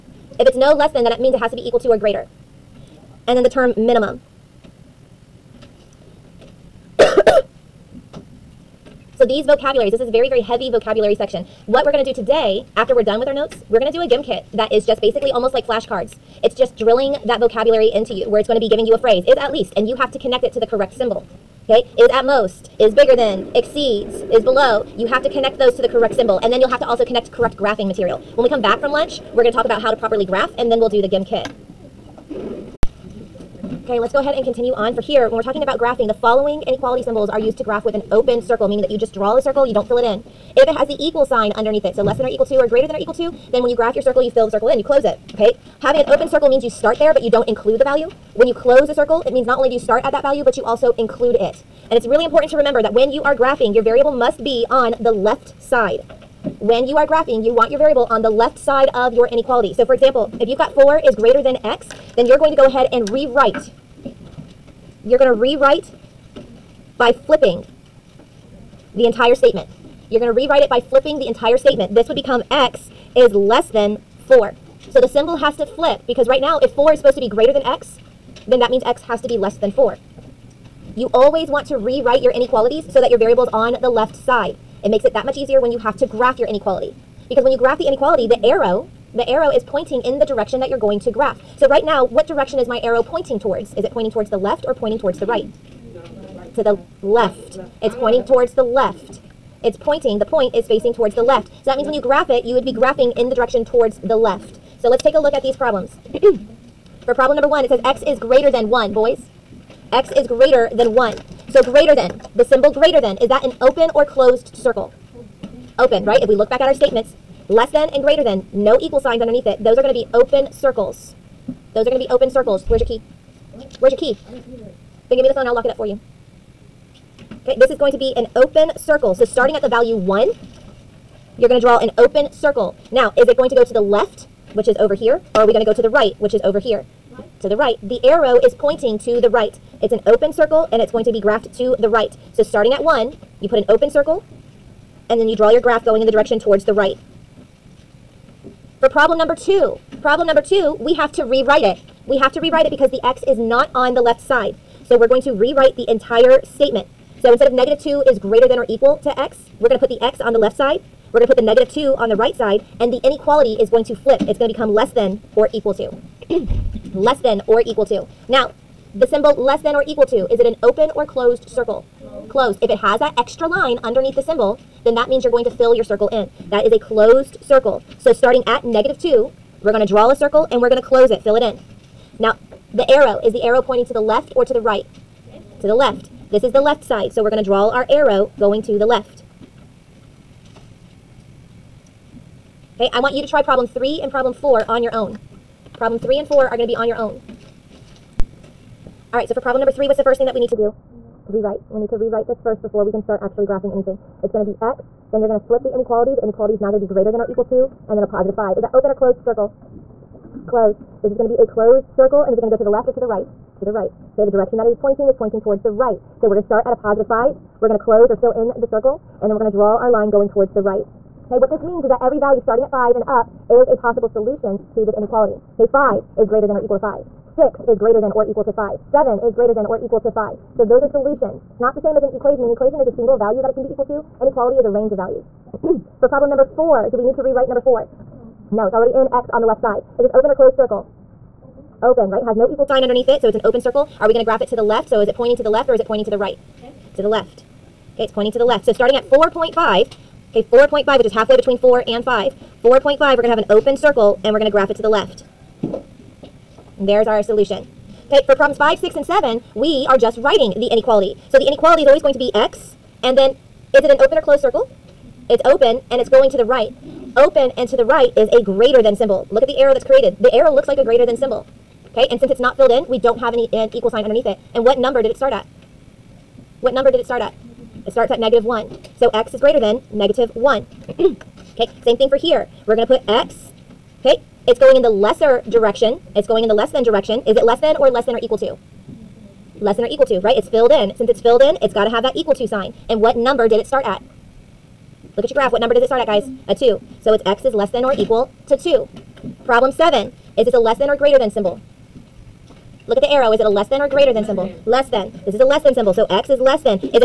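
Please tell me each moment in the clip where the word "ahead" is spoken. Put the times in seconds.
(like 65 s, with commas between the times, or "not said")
34 s, 62 s.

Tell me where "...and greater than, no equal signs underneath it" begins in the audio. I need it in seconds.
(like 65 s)
117 s.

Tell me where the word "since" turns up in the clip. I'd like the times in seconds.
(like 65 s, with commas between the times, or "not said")
272 s, 290 s.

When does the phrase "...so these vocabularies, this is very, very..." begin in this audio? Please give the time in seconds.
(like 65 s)
9 s.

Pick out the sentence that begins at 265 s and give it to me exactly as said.
It's open, and it's going to the right.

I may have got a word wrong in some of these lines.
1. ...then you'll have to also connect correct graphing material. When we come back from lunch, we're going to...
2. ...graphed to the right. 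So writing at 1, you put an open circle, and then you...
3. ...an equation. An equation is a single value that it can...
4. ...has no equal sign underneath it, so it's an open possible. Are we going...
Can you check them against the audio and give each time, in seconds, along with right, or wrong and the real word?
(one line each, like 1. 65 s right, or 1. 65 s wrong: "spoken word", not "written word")
1. 26 s right
2. 141 s wrong: "starting", not "writing"
3. 232 s right
4. 242 s wrong: "circle", not "possible".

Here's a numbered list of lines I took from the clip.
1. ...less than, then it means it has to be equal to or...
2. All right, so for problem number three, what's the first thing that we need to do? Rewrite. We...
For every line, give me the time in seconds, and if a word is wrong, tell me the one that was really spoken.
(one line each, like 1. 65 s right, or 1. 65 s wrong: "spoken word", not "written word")
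1. 0 s right
2. 199 s right.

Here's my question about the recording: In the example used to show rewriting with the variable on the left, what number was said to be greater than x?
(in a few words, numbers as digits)
4.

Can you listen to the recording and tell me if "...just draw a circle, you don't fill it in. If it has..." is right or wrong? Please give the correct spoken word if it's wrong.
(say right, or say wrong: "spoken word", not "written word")
right.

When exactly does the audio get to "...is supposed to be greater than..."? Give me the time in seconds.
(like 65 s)
76 s.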